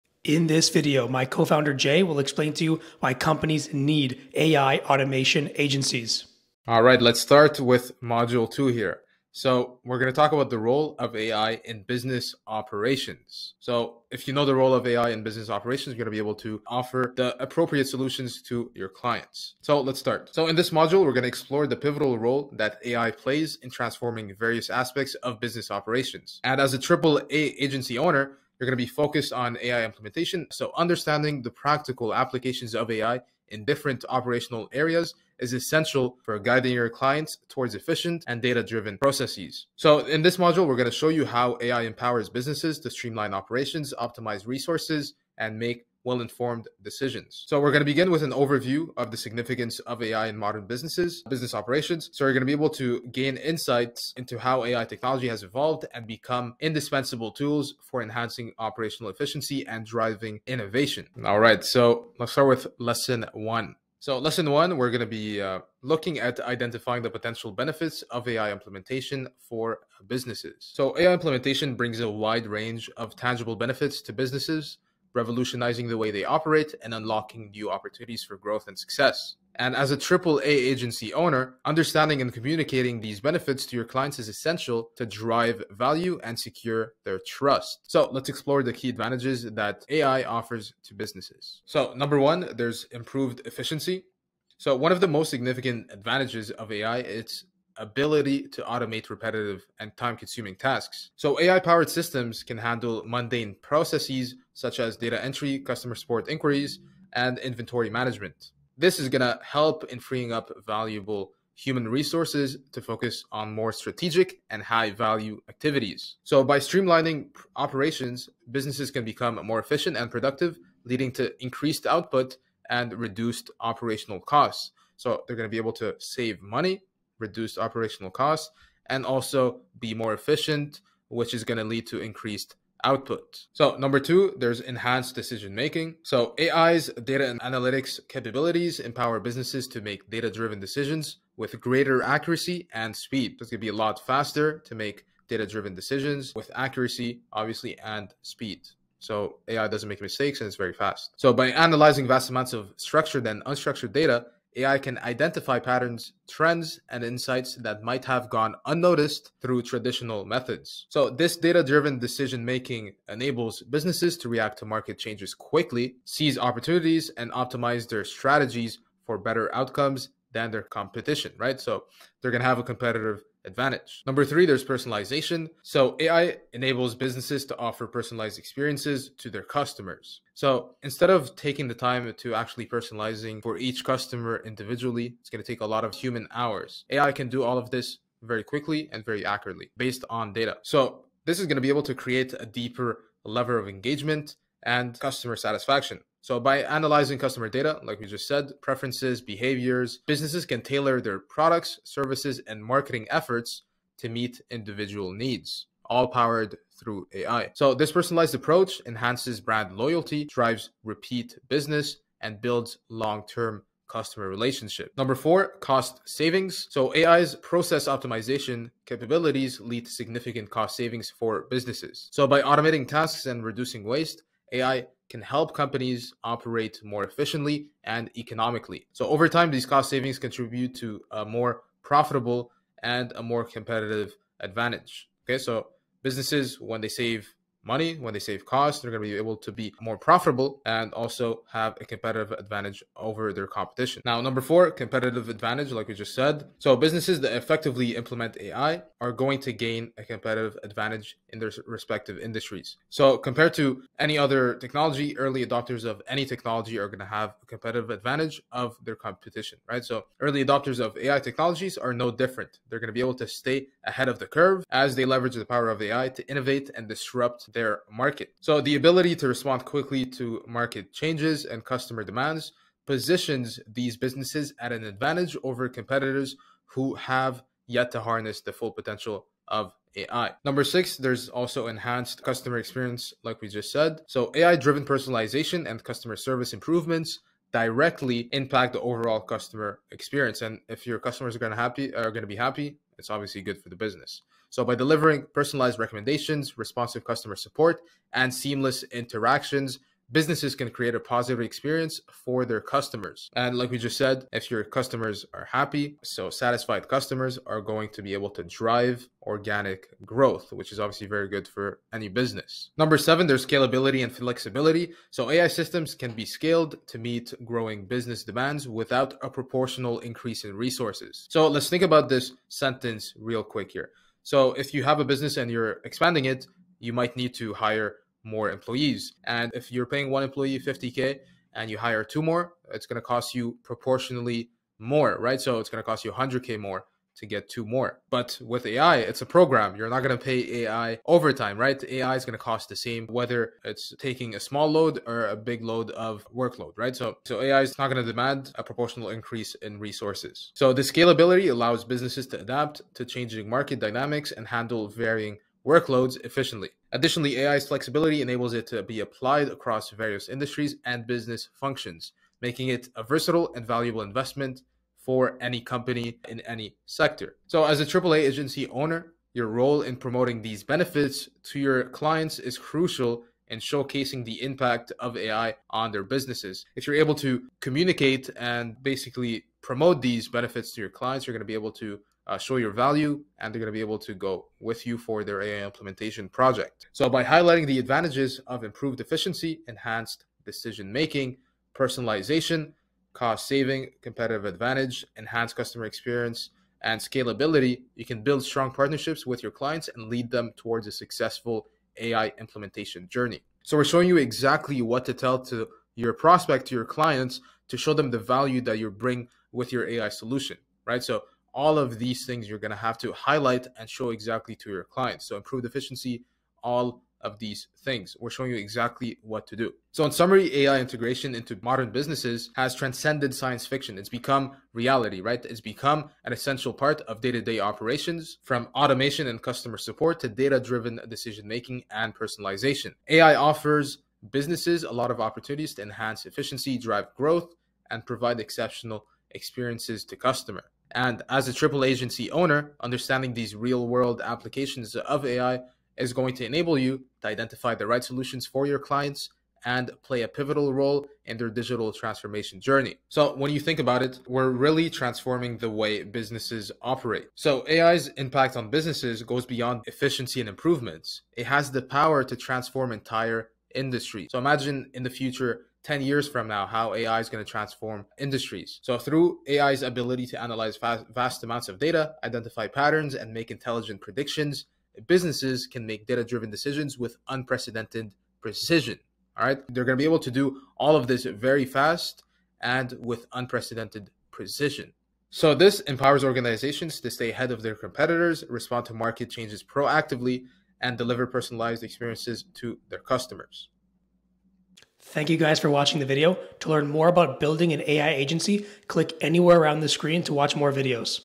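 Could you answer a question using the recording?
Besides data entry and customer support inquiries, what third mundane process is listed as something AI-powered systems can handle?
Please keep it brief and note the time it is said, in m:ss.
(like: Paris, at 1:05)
Inventory management, at 1:47.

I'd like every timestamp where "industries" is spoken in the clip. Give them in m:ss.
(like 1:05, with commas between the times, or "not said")
4:12, 6:00, 7:43, 7:48.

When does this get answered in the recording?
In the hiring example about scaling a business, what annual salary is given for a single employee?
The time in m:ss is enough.
5:30.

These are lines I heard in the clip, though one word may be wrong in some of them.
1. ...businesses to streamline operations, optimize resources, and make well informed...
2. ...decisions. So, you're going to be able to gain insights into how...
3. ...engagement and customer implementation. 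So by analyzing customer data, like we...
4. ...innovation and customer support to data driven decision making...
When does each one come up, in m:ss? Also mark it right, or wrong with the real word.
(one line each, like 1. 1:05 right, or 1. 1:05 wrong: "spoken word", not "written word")
1. 0:42 right
2. 0:51 wrong: "operations", not "decisions"
3. 3:13 wrong: "satisfaction", not "implementation"
4. 7:08 wrong: "automation", not "innovation".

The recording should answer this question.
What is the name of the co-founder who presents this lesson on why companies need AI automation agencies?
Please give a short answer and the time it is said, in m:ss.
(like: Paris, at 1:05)
Jay, at 0:01.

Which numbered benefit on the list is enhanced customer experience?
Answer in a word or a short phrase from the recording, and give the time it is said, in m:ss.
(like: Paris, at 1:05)
6, at 4:40.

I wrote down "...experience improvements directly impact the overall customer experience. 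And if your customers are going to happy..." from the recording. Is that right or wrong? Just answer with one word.
wrong.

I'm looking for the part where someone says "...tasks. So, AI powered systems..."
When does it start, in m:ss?
1:40.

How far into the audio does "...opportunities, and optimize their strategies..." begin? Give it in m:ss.
2:46.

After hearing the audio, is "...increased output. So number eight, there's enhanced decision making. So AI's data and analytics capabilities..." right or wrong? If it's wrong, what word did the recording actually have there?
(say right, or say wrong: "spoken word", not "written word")
wrong: "two", not "eight".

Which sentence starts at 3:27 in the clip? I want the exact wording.
So this personalized approach enhances brand loyalty, drives repeat business, and builds long-term customer relationship.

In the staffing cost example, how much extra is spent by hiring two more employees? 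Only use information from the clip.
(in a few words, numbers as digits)
100K.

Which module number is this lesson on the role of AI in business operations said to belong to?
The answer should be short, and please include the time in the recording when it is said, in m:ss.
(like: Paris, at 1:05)
2, at 0:08.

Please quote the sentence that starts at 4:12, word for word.
So, compared to any other technology, early adopters of any technology are going to have a competitive advantage of their competition, right?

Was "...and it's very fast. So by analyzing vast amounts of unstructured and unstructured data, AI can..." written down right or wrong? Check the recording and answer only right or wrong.
wrong.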